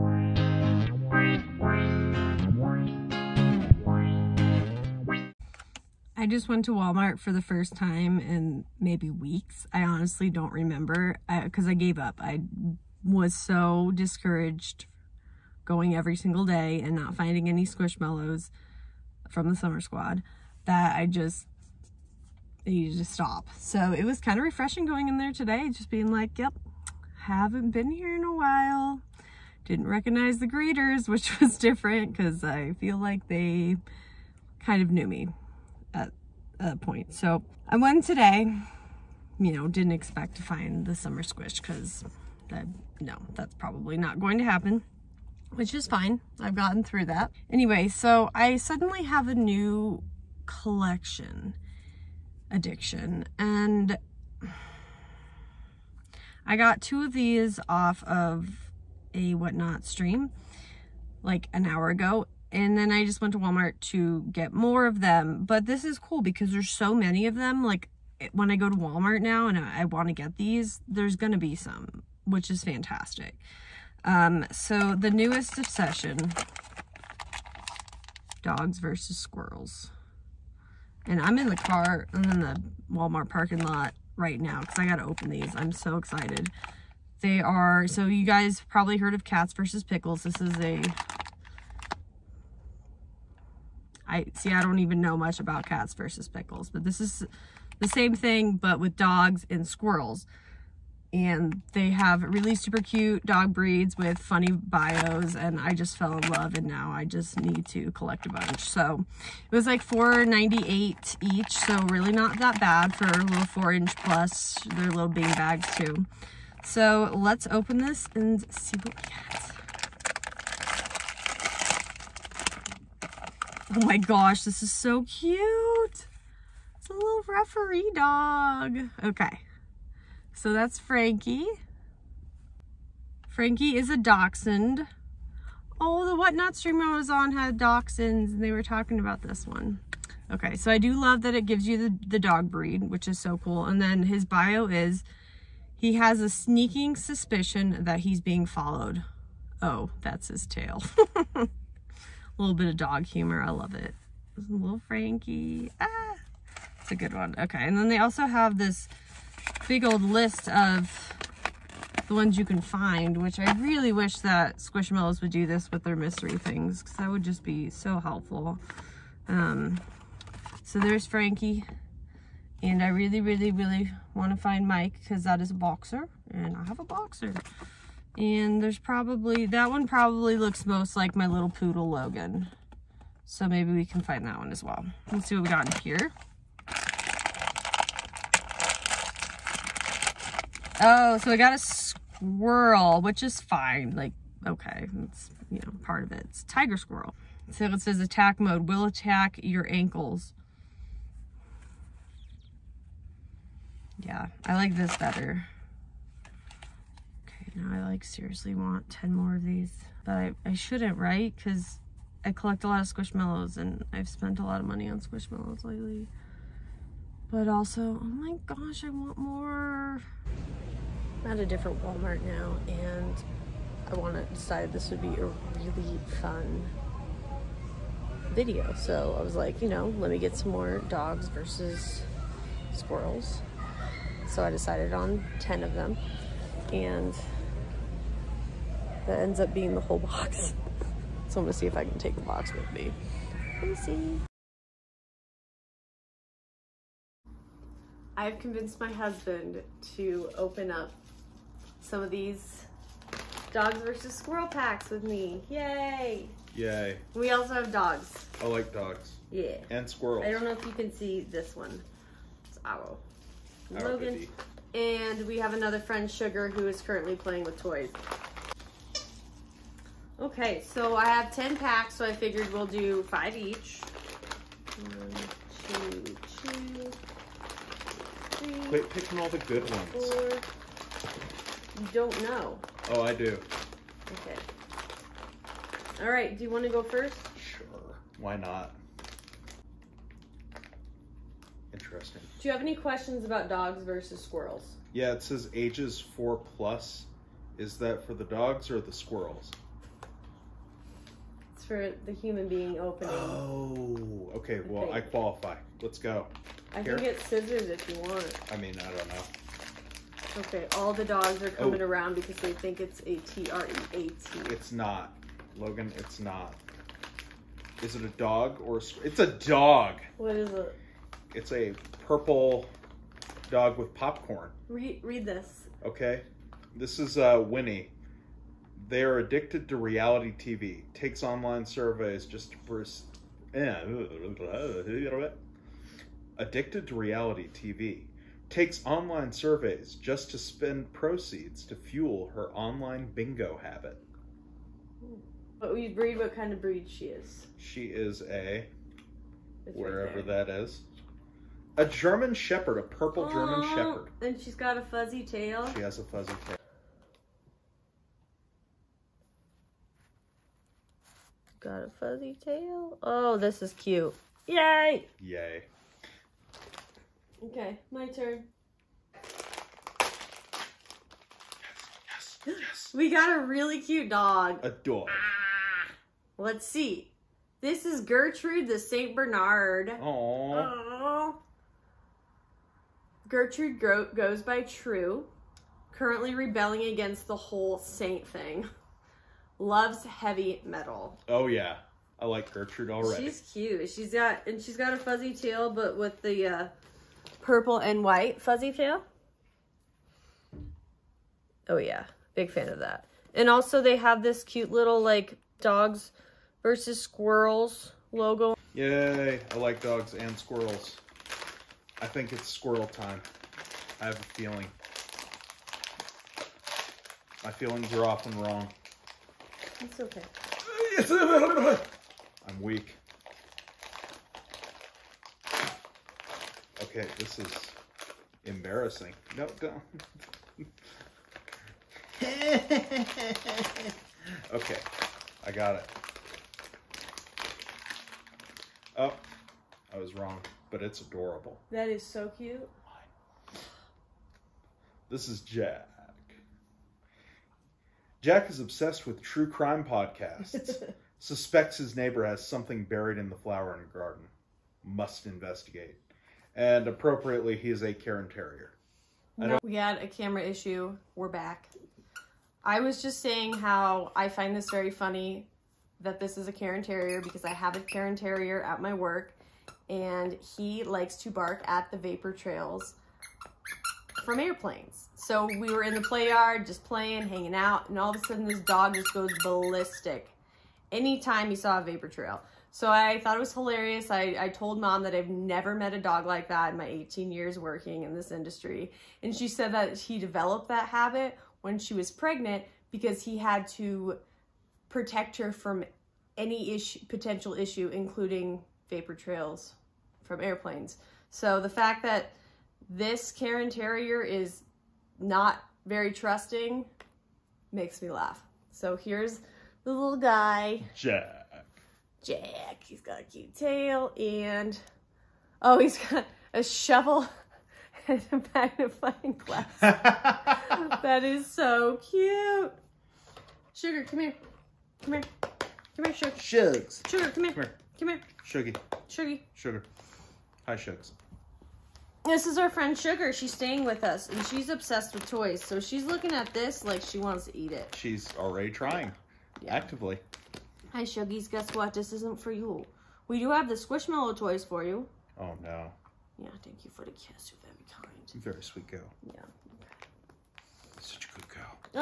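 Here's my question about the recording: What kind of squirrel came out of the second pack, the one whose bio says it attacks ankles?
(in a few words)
Tiger squirrel.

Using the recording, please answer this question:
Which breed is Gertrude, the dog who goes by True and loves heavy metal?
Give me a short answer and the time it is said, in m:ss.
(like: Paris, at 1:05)
St. Bernard, at 6:18.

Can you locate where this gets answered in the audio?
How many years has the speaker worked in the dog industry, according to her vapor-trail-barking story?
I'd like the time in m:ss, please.
8:06.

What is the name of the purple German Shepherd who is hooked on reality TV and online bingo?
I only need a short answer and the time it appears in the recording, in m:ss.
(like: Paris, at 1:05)
Winnie, at 5:27.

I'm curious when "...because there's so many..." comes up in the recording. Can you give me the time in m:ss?
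1:06.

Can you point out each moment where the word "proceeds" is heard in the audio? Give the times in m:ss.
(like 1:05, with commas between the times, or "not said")
5:40.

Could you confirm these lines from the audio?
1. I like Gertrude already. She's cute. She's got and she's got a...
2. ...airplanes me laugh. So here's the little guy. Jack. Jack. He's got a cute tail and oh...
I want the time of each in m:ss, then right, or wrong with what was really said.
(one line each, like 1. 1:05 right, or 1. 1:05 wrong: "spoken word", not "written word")
1. 6:32 right
2. 8:27 wrong: "makes", not "airplanes".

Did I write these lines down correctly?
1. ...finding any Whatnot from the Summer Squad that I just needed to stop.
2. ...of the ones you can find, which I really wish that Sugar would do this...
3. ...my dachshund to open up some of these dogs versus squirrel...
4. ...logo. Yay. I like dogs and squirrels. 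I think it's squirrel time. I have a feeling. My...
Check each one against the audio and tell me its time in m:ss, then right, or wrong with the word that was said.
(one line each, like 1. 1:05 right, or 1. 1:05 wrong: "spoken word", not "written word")
1. 0:17 wrong: "Squishmallows", not "Whatnot"
2. 2:40 wrong: "Squishmallows", not "Sugar"
3. 4:08 wrong: "husband", not "dachshund"
4. 6:48 right.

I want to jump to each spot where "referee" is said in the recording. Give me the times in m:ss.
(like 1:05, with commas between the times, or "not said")
2:07.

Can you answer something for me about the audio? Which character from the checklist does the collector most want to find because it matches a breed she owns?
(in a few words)
Mike.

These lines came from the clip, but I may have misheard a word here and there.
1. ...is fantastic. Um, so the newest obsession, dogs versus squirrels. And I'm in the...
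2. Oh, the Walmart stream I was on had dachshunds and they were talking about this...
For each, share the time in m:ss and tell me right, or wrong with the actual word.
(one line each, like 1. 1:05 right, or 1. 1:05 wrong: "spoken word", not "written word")
1. 1:12 right
2. 2:15 wrong: "Whatnot", not "Walmart".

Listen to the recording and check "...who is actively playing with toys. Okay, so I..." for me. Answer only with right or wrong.
wrong.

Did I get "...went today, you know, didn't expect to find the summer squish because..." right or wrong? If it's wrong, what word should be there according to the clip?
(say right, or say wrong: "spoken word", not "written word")
right.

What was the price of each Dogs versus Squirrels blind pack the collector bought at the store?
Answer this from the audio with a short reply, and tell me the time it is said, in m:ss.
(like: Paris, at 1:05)
$4.98, at 1:49.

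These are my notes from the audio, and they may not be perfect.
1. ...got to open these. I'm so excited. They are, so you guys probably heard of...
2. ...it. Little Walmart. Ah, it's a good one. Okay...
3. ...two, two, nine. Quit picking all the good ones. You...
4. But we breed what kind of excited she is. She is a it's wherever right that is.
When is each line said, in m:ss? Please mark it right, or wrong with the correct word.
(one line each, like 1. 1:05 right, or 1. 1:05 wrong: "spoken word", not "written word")
1. 1:24 right
2. 2:33 wrong: "Frankie", not "Walmart"
3. 4:35 wrong: "three", not "nine"
4. 5:45 wrong: "breed", not "excited".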